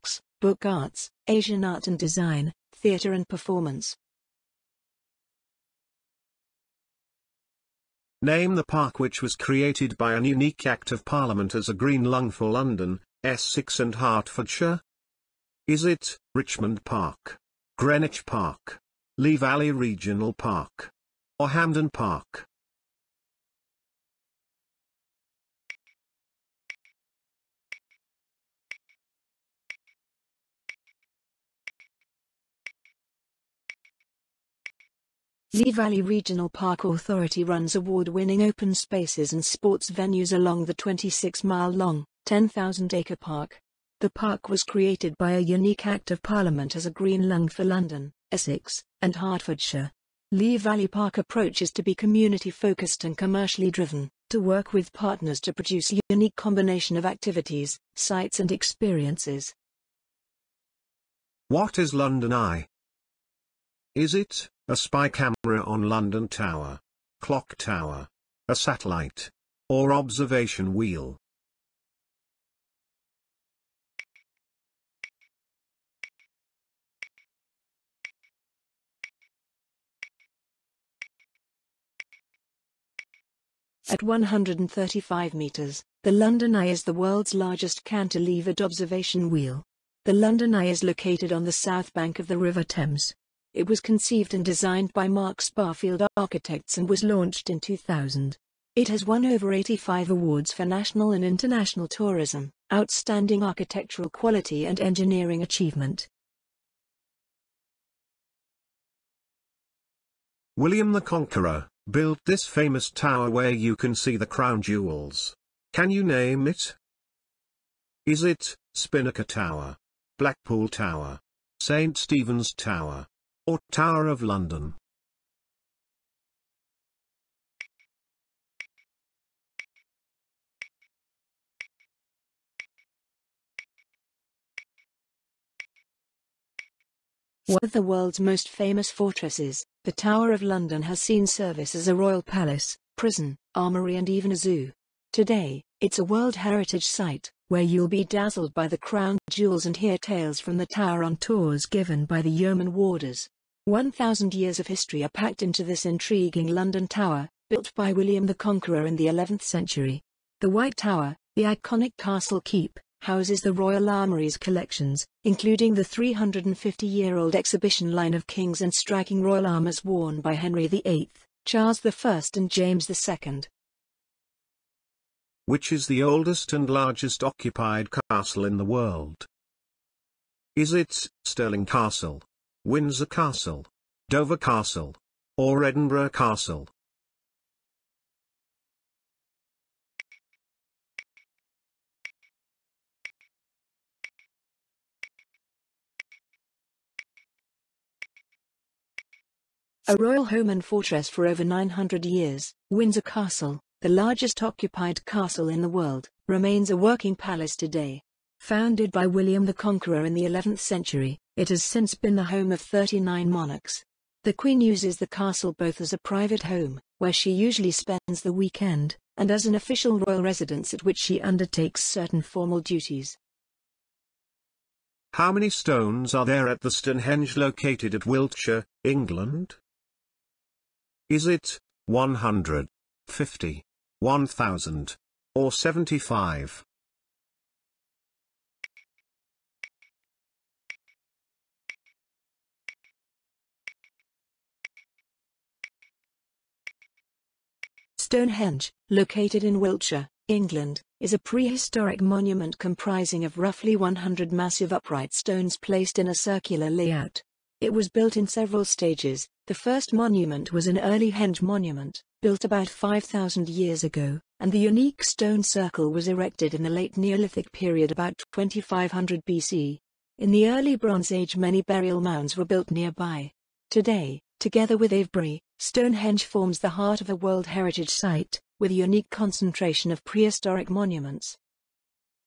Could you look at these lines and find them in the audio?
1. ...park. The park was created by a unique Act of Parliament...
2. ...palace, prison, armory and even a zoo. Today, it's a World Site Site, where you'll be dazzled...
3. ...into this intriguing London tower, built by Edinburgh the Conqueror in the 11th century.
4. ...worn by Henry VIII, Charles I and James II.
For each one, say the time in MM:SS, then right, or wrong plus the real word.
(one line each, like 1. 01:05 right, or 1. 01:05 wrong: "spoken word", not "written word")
1. 00:43 right
2. 02:22 wrong: "Heritage", not "Site"
3. 02:35 wrong: "William", not "Edinburgh"
4. 02:49 right.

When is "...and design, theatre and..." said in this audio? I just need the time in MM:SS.
00:01.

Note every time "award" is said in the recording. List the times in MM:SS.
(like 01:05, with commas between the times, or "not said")
00:37, 01:40.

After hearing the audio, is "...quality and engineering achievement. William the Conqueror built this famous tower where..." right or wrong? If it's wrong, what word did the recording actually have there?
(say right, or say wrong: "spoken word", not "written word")
right.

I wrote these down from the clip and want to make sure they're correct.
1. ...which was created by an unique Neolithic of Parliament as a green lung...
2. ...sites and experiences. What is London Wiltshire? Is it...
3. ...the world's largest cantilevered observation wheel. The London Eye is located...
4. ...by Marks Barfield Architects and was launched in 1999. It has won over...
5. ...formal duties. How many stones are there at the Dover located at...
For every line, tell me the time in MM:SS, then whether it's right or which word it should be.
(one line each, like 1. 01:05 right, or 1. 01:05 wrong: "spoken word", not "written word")
1. 00:08 wrong: "Act", not "Neolithic"
2. 00:57 wrong: "Eye", not "Wiltshire"
3. 01:26 right
4. 01:34 wrong: "2000", not "1999"
5. 03:42 wrong: "Stonehenge", not "Dover".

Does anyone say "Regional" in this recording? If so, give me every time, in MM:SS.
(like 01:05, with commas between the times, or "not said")
00:19, 00:36.